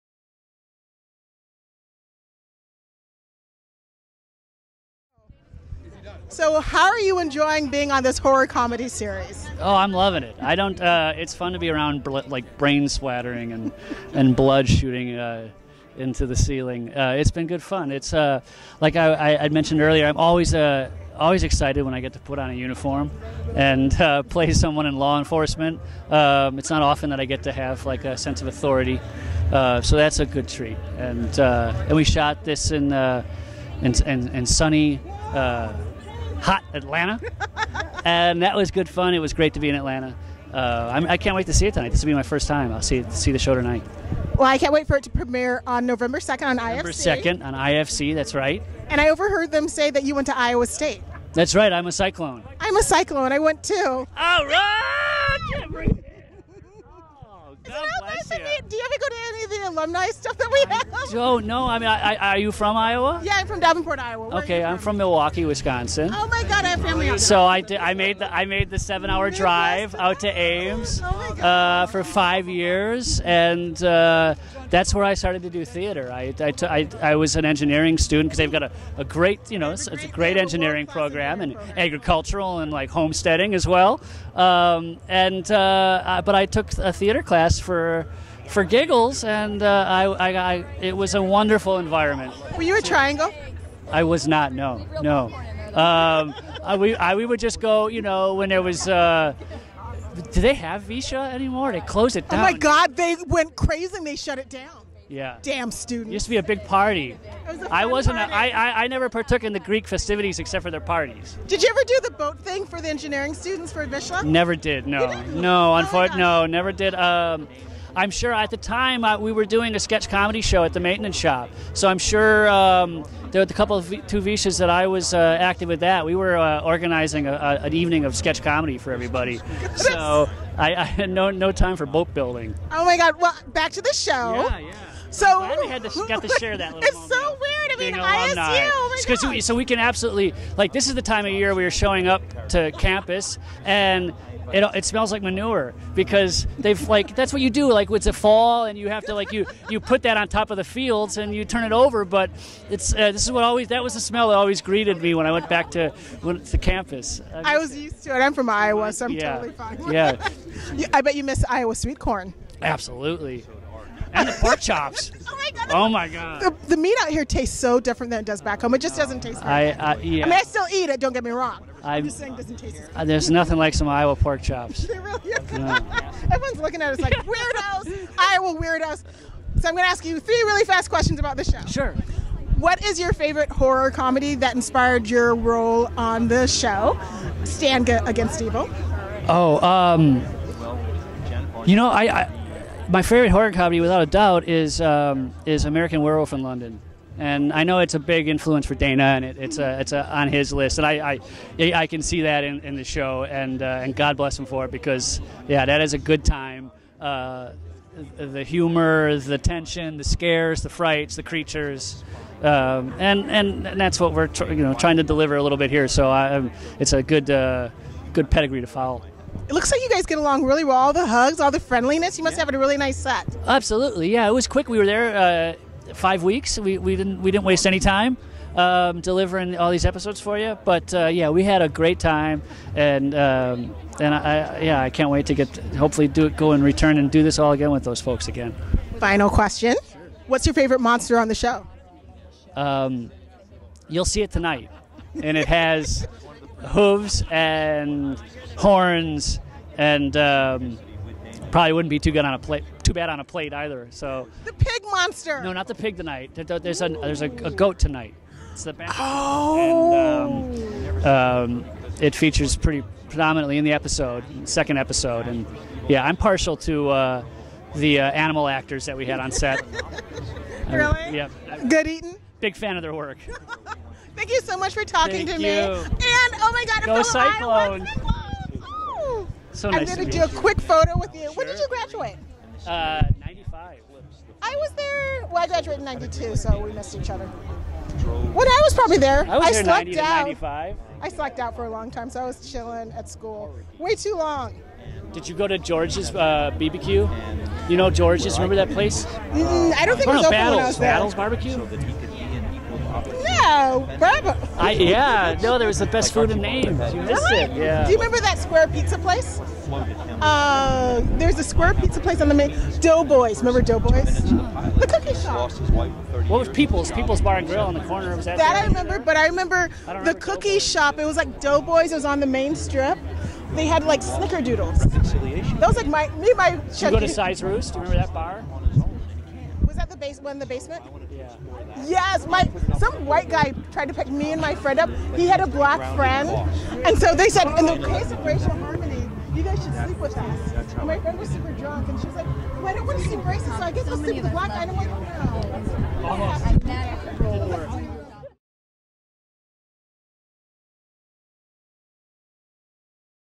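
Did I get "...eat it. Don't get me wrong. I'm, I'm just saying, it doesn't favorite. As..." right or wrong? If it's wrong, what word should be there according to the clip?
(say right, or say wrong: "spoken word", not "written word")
wrong: "taste", not "favorite".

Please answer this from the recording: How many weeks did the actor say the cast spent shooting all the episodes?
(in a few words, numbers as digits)
5 weeks.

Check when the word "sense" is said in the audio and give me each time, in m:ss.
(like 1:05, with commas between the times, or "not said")
0:28.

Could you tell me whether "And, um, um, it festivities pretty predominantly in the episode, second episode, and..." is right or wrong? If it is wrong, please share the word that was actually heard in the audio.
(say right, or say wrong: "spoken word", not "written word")
wrong: "features", not "festivities".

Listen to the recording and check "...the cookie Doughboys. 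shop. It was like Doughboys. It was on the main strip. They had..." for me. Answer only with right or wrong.
right.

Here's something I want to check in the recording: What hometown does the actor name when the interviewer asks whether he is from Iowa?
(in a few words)
Milwaukee, Wisconsin.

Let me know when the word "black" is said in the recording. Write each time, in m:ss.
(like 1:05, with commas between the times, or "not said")
5:35, 5:44.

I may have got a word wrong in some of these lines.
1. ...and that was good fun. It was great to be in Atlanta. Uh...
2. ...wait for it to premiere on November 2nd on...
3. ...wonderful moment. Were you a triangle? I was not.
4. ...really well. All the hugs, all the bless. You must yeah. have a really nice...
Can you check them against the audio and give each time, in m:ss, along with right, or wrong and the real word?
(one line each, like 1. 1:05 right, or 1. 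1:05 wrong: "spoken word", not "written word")
1. 0:38 right
2. 0:44 right
3. 1:31 wrong: "environment", not "moment"
4. 3:40 wrong: "friendliness", not "bless".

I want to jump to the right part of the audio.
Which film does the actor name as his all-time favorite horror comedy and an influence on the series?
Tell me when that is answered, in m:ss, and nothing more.
3:15.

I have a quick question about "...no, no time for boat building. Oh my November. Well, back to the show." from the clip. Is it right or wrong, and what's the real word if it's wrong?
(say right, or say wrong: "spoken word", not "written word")
wrong: "God", not "November".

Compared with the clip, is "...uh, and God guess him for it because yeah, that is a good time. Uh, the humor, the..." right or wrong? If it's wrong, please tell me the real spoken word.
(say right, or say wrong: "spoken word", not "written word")
wrong: "bless", not "guess".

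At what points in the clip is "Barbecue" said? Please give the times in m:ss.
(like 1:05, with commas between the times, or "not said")
5:01.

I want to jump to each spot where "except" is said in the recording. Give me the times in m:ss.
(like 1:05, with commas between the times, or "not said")
1:50.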